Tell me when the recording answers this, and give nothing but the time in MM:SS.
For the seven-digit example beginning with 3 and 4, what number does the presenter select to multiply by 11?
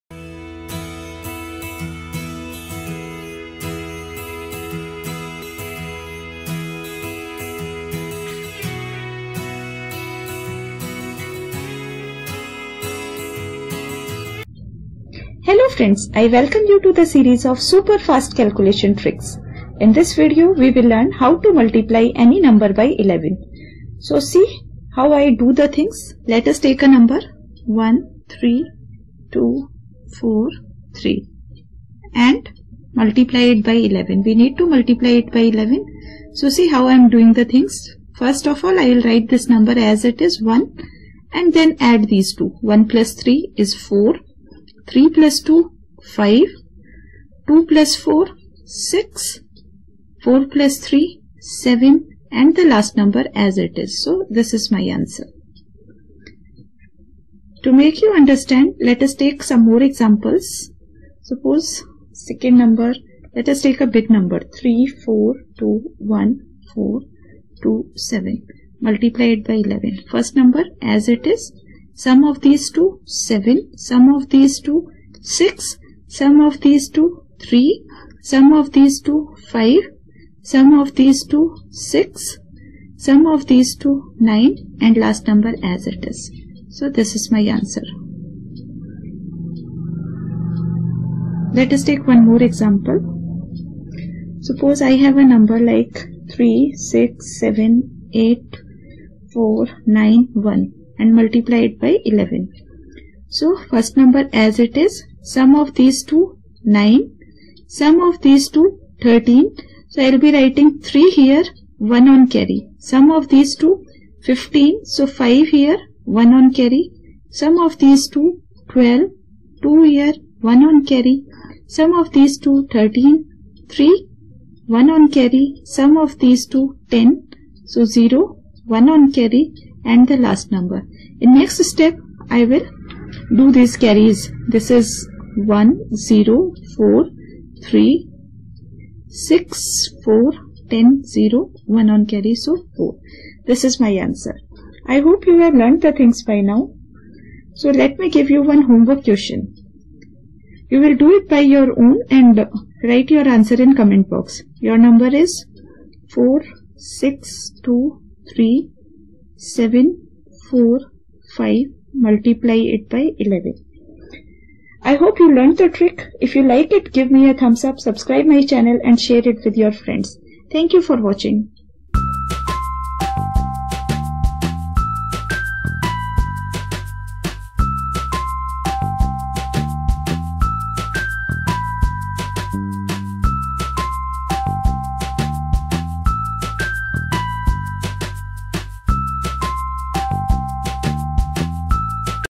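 01:04.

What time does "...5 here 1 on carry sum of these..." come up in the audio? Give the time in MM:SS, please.
01:55.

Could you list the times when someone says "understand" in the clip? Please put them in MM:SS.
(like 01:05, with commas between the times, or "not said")
00:58.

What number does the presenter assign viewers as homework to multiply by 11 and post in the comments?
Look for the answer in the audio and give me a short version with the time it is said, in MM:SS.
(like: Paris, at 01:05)
4623745, at 02:36.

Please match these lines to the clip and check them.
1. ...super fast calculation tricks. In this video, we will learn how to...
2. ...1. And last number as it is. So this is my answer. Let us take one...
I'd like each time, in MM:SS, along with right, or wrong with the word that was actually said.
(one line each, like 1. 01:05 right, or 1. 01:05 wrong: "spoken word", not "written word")
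1. 00:17 right
2. 01:24 wrong: "9", not "1".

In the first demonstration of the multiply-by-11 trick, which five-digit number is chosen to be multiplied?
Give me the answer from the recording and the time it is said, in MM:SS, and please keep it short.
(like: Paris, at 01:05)
13243, at 00:27.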